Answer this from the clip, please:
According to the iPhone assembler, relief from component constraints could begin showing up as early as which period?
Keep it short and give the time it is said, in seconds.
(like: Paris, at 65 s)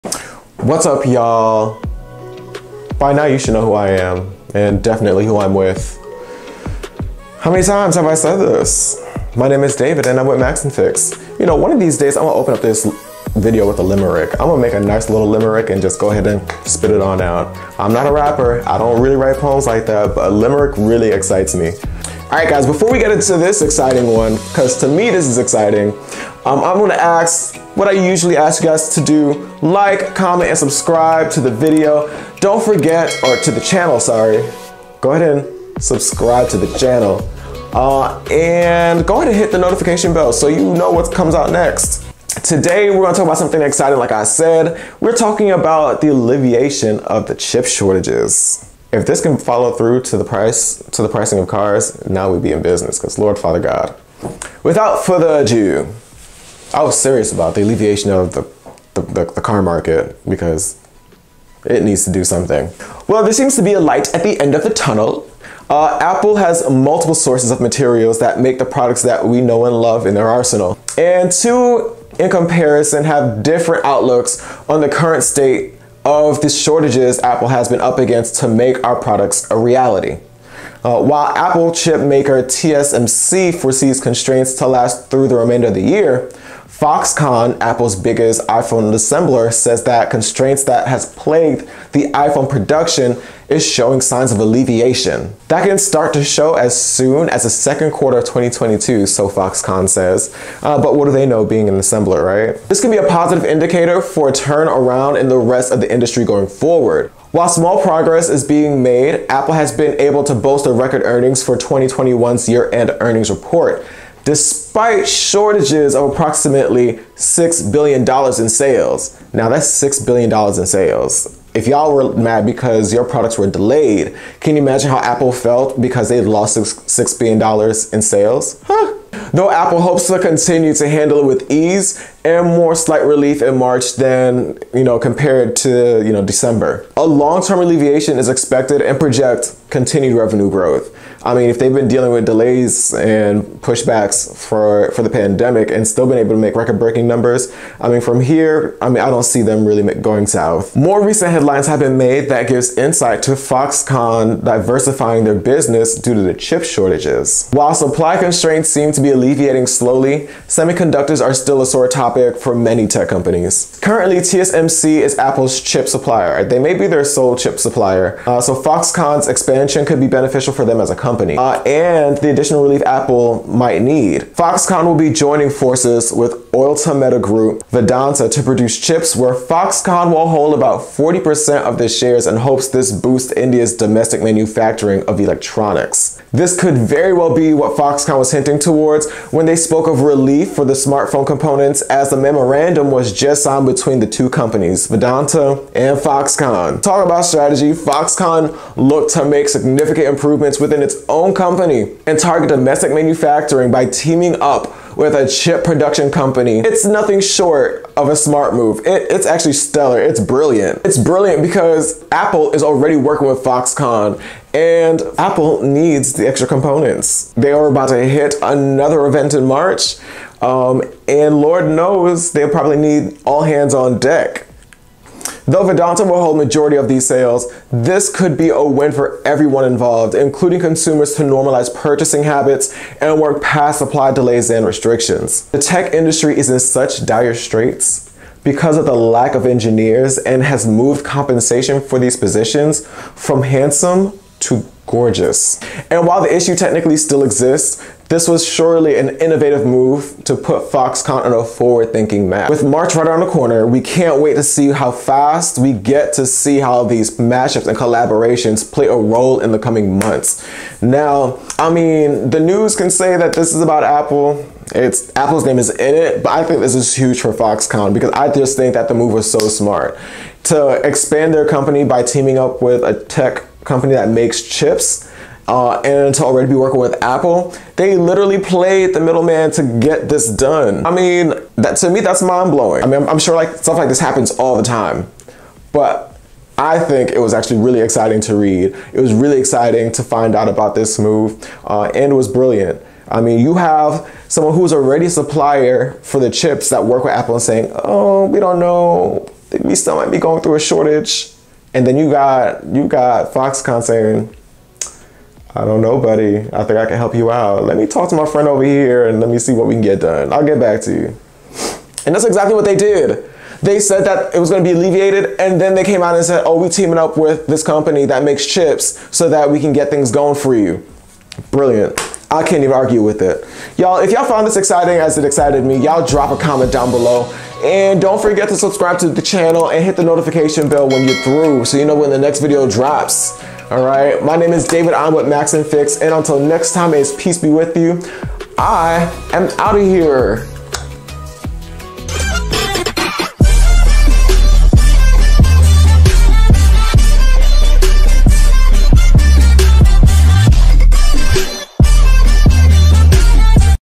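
second quarter of 2022, at 97 s.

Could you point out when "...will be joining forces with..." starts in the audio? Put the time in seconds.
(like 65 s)
174 s.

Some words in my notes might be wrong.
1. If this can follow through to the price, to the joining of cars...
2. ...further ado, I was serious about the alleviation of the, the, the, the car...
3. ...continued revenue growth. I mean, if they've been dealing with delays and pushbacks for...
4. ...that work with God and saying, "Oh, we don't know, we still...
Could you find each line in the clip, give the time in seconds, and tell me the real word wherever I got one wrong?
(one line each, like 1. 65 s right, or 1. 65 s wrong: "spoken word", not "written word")
1. 48 s wrong: "pricing", not "joining"
2. 55 s right
3. 139 s right
4. 296 s wrong: "Apple", not "God".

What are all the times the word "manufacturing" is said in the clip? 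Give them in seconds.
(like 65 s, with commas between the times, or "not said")
184 s, 202 s.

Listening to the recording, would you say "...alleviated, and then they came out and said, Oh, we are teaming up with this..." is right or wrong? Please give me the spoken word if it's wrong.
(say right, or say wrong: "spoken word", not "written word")
right.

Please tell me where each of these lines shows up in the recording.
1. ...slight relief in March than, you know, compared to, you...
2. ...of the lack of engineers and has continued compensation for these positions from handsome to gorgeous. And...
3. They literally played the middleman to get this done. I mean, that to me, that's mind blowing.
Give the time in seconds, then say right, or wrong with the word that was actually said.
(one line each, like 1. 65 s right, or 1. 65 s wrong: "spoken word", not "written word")
1. 132 s right
2. 238 s wrong: "moved", not "continued"
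3. 277 s right.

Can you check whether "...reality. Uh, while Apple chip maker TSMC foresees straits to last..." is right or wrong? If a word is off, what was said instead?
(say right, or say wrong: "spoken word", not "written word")
wrong: "constraints", not "straits".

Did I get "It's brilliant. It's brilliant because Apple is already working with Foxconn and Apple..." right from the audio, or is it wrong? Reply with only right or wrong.
right.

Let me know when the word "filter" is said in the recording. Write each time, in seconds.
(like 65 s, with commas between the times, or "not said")
not said.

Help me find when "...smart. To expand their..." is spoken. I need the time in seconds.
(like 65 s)
269 s.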